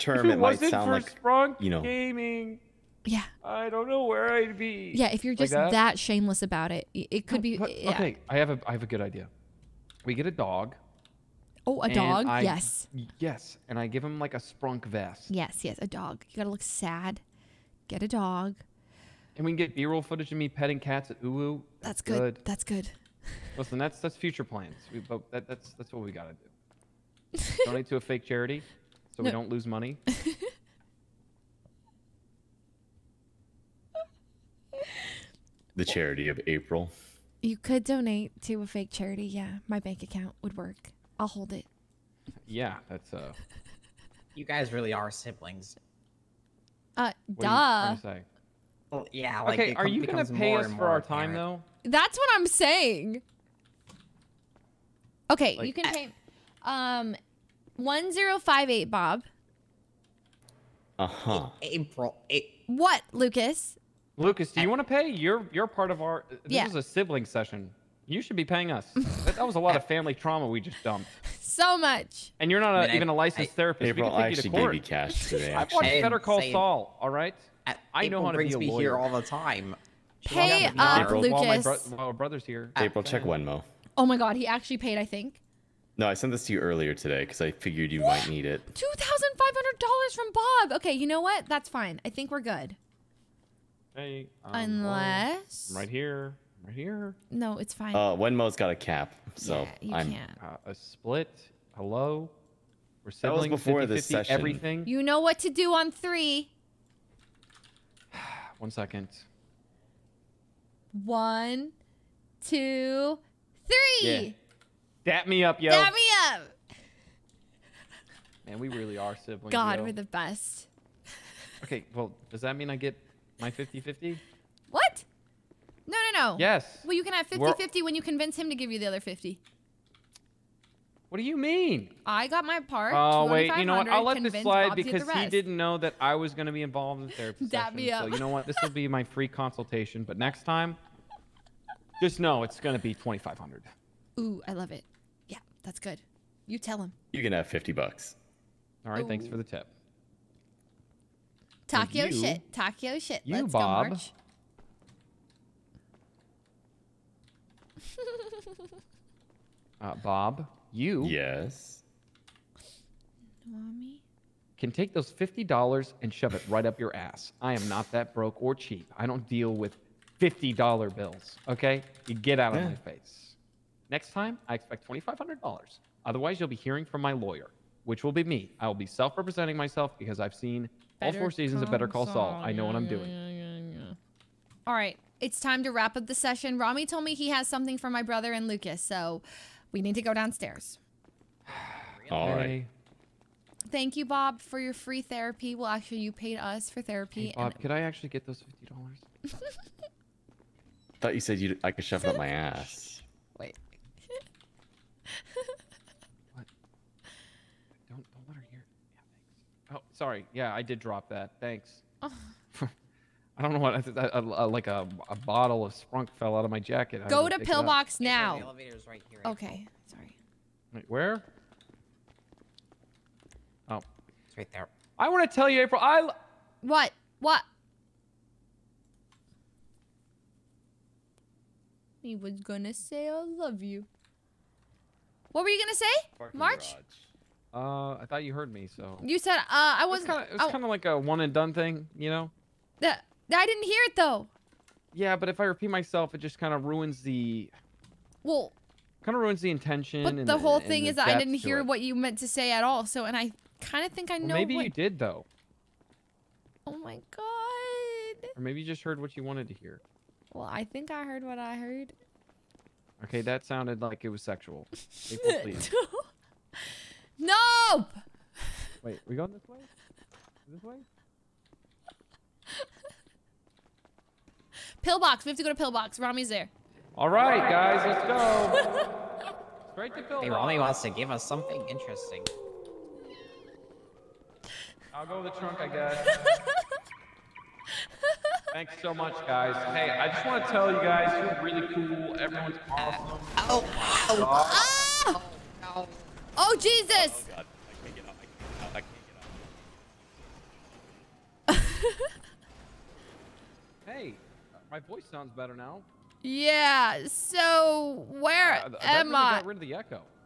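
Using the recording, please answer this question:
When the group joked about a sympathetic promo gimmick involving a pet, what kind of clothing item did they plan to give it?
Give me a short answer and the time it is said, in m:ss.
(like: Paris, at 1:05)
Sprunk vest, at 0:14.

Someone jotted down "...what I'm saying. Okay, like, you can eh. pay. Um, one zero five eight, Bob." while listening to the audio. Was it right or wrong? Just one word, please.
right.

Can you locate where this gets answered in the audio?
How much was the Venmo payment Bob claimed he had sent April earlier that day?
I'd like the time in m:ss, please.
1:28.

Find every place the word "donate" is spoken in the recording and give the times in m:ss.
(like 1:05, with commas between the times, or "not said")
0:27, 0:37.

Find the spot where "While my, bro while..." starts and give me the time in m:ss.
1:21.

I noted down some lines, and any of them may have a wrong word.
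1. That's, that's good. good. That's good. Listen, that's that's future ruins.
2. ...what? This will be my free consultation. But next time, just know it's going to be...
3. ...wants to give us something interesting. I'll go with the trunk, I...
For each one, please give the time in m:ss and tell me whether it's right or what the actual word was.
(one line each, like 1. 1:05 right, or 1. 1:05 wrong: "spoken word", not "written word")
1. 0:21 wrong: "plans", not "ruins"
2. 2:18 right
3. 4:40 right.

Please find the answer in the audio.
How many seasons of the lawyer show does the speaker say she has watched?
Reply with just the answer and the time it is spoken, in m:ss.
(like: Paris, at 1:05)
4, at 3:01.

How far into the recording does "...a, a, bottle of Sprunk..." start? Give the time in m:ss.
3:34.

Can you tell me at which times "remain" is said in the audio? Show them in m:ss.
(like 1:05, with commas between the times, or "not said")
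not said.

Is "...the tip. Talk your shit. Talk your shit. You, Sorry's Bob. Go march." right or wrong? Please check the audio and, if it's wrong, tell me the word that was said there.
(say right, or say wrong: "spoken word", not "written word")
wrong: "Let", not "Sorry".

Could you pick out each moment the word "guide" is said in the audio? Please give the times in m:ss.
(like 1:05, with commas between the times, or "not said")
not said.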